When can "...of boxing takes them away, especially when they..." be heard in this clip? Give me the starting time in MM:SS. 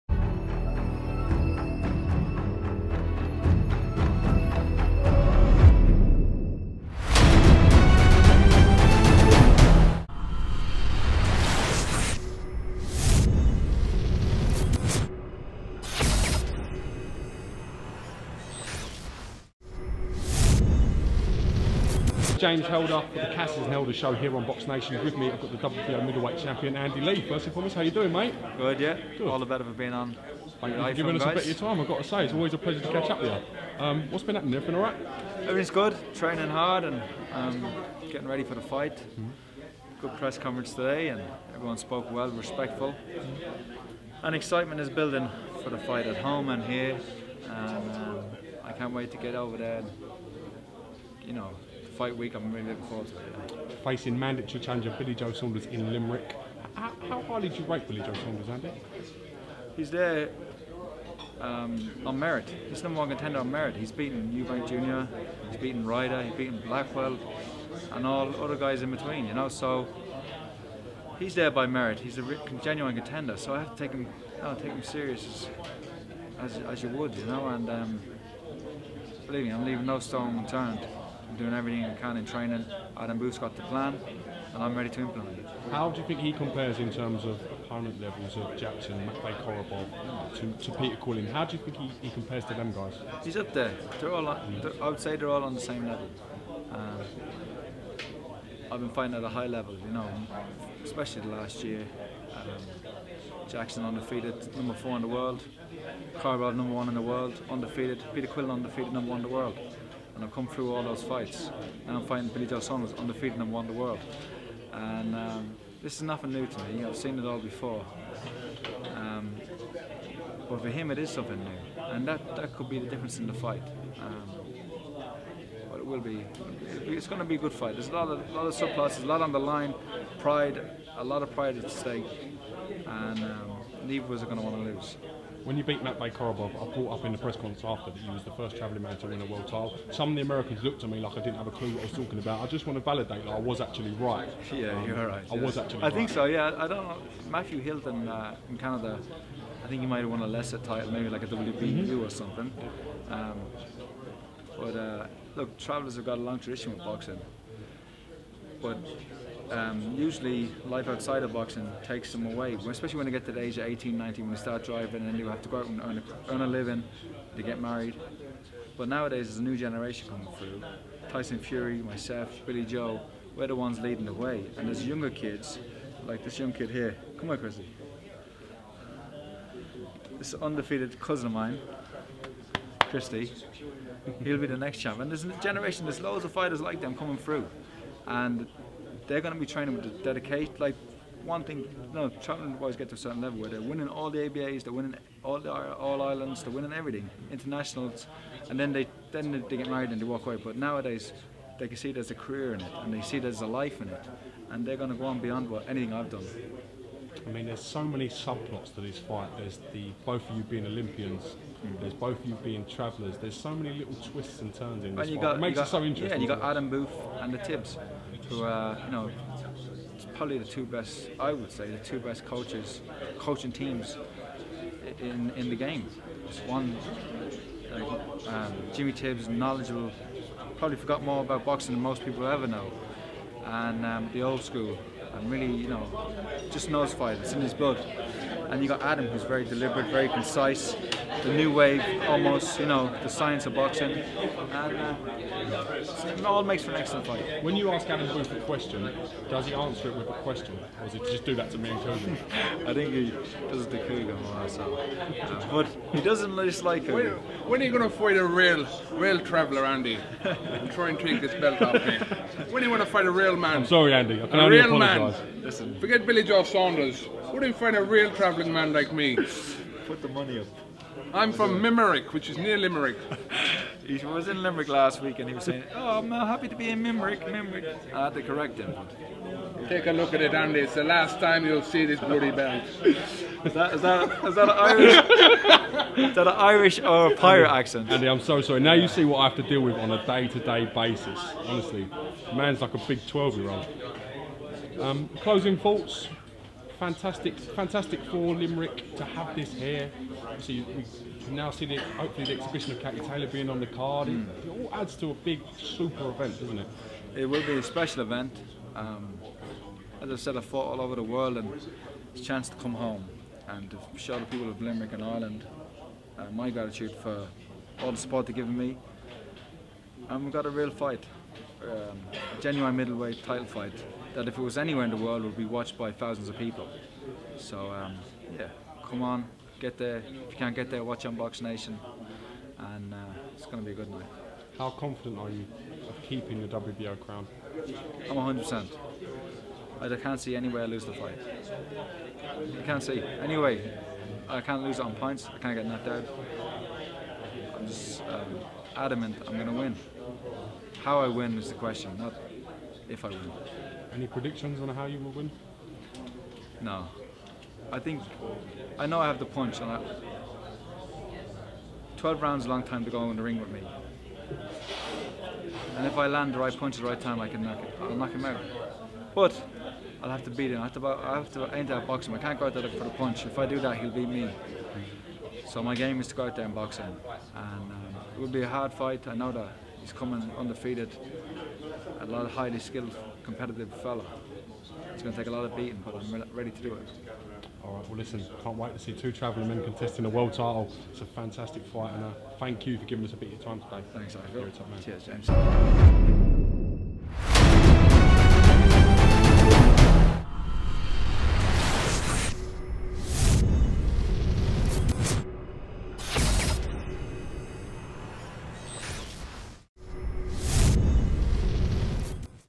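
02:41.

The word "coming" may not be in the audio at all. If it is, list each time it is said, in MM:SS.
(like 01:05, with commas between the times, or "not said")
02:50, 03:06, 06:19.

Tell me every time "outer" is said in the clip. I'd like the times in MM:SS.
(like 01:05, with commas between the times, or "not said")
not said.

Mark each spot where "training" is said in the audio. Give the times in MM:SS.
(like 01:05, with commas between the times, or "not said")
00:36, 01:22, 03:09.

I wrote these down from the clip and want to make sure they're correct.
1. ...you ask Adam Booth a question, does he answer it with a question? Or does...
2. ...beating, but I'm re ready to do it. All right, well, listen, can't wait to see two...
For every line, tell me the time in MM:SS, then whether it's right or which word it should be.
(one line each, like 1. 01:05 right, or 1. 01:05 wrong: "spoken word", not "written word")
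1. 04:07 right
2. 06:25 right.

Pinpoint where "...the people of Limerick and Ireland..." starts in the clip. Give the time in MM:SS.
05:14.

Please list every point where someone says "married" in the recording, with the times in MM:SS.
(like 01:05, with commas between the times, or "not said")
02:47, 03:19.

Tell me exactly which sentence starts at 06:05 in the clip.
And if I land the right punch at the right time, I can knock it.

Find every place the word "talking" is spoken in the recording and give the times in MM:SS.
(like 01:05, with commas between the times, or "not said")
02:21.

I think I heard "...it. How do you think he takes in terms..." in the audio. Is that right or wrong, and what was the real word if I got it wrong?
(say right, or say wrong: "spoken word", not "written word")
wrong: "compares", not "takes".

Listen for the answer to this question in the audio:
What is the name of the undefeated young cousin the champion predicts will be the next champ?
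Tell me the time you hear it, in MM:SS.
03:02.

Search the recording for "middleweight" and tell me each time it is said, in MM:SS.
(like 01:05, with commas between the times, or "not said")
00:26, 05:22.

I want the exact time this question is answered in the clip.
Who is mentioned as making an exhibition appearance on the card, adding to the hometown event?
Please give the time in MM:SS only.
05:02.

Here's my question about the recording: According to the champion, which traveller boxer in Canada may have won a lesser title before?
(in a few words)
Matthew Hilton.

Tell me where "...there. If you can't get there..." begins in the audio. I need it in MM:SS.
05:29.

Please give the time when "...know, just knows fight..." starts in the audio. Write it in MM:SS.
03:55.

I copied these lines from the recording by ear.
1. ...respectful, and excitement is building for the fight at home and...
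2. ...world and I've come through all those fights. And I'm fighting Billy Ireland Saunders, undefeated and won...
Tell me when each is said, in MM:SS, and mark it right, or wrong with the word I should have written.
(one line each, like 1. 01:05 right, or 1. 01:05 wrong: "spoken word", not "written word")
1. 00:42 right
2. 01:49 wrong: "Joe", not "Ireland".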